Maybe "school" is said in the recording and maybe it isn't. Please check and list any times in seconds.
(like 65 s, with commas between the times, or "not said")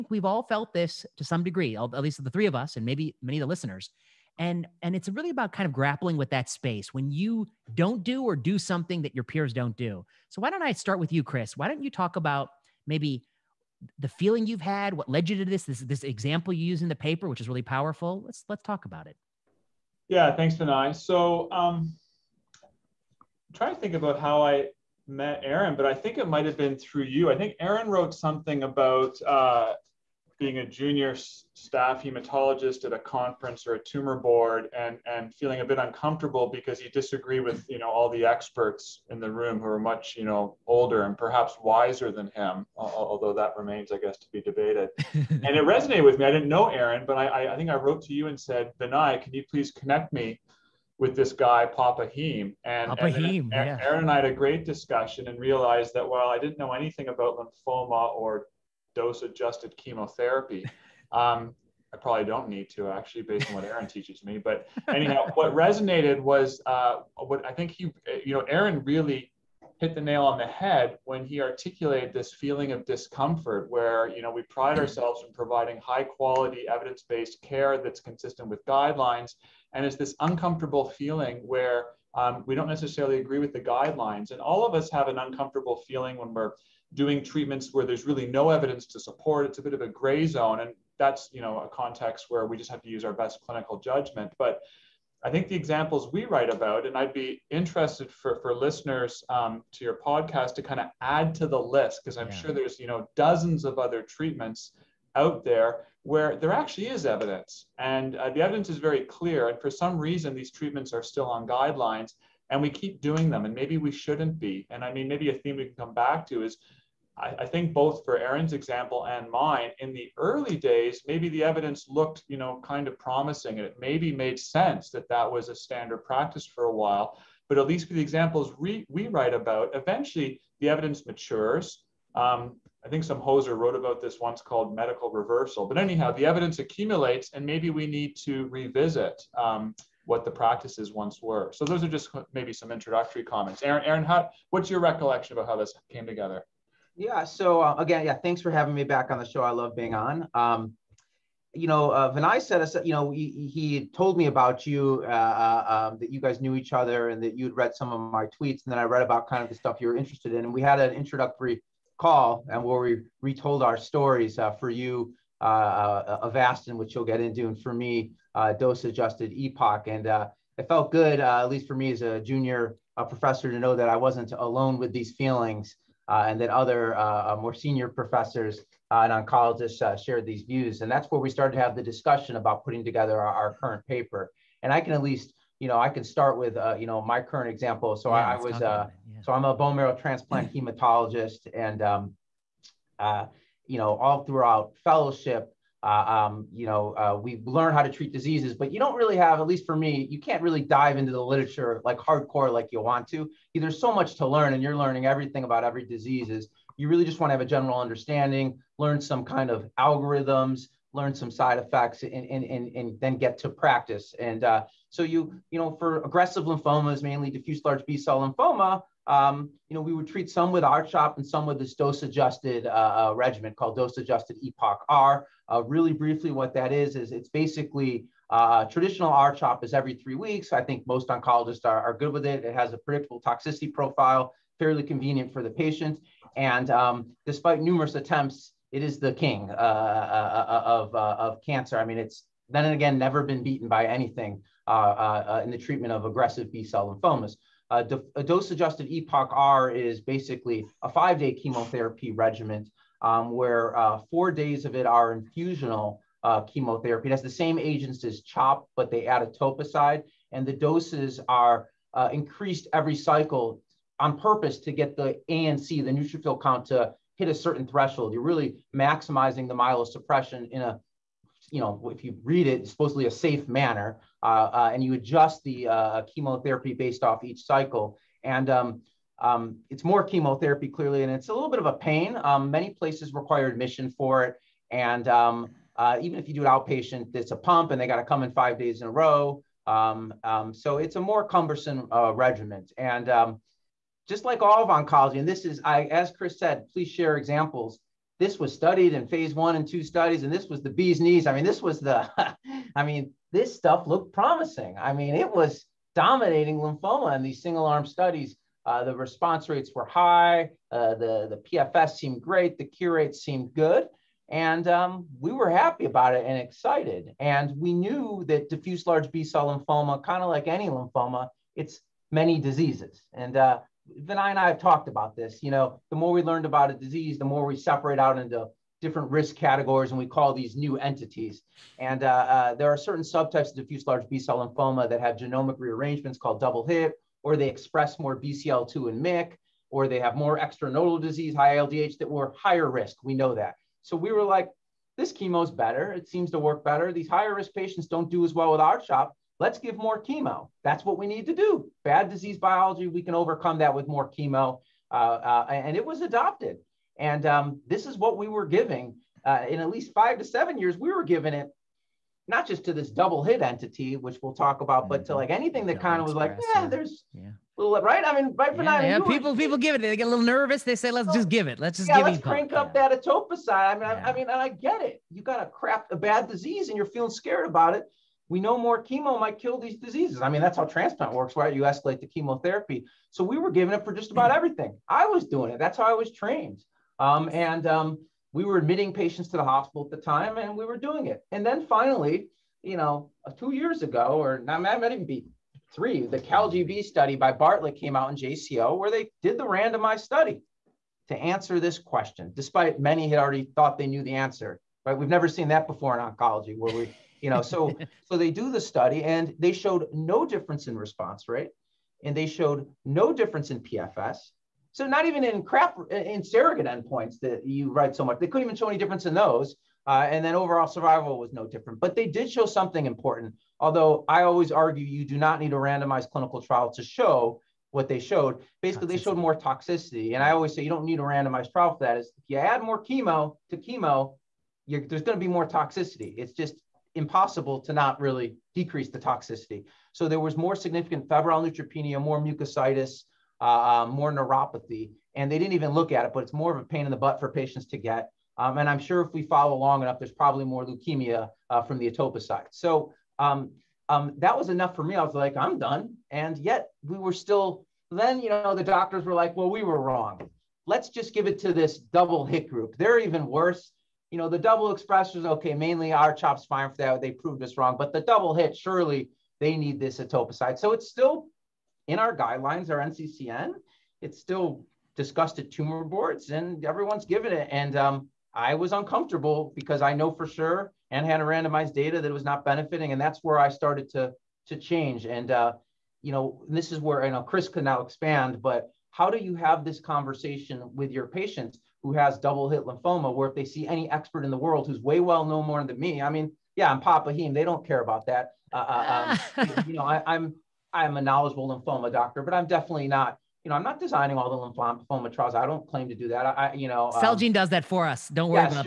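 not said.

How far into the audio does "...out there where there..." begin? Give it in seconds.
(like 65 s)
105 s.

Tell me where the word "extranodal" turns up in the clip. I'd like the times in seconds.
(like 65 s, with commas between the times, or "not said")
340 s.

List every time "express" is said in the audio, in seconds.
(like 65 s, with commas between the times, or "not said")
337 s, 464 s.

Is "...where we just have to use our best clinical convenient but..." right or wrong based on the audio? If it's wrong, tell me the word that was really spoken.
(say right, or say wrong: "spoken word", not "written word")
wrong: "judgment", not "convenient".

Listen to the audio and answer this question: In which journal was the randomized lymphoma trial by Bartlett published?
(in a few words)
JCO.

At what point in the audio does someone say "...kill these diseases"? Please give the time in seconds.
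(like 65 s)
379 s.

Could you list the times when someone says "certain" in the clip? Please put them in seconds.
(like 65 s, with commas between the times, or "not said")
267 s, 332 s.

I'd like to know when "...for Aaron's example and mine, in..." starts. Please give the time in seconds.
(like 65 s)
118 s.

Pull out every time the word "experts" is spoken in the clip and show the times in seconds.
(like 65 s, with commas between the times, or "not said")
38 s, 493 s.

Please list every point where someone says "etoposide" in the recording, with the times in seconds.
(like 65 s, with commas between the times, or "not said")
259 s, 373 s, 469 s.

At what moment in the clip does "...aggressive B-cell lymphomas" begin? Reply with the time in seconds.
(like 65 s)
246 s.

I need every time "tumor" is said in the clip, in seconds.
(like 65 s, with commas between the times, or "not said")
33 s, 475 s.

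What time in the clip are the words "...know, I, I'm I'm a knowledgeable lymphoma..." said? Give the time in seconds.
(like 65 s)
499 s.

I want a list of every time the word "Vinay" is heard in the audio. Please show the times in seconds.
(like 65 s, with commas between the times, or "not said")
20 s, 48 s, 152 s, 324 s.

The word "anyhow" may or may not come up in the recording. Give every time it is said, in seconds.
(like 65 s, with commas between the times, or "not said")
64 s, 135 s.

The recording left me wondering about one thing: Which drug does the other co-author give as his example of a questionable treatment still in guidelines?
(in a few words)
Avastin.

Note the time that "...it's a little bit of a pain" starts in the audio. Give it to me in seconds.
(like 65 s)
281 s.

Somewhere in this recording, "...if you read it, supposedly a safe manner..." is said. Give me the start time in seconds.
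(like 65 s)
271 s.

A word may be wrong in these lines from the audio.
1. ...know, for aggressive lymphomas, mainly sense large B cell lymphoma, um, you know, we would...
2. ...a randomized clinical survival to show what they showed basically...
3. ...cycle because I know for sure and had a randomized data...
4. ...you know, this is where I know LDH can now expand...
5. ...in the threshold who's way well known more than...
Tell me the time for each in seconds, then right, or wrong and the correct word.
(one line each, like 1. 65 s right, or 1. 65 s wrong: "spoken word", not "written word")
1. 215 s wrong: "diffuse", not "sense"
2. 425 s wrong: "trial", not "survival"
3. 478 s wrong: "uncomfortable", not "cycle"
4. 486 s wrong: "Chris", not "LDH"
5. 494 s wrong: "world", not "threshold".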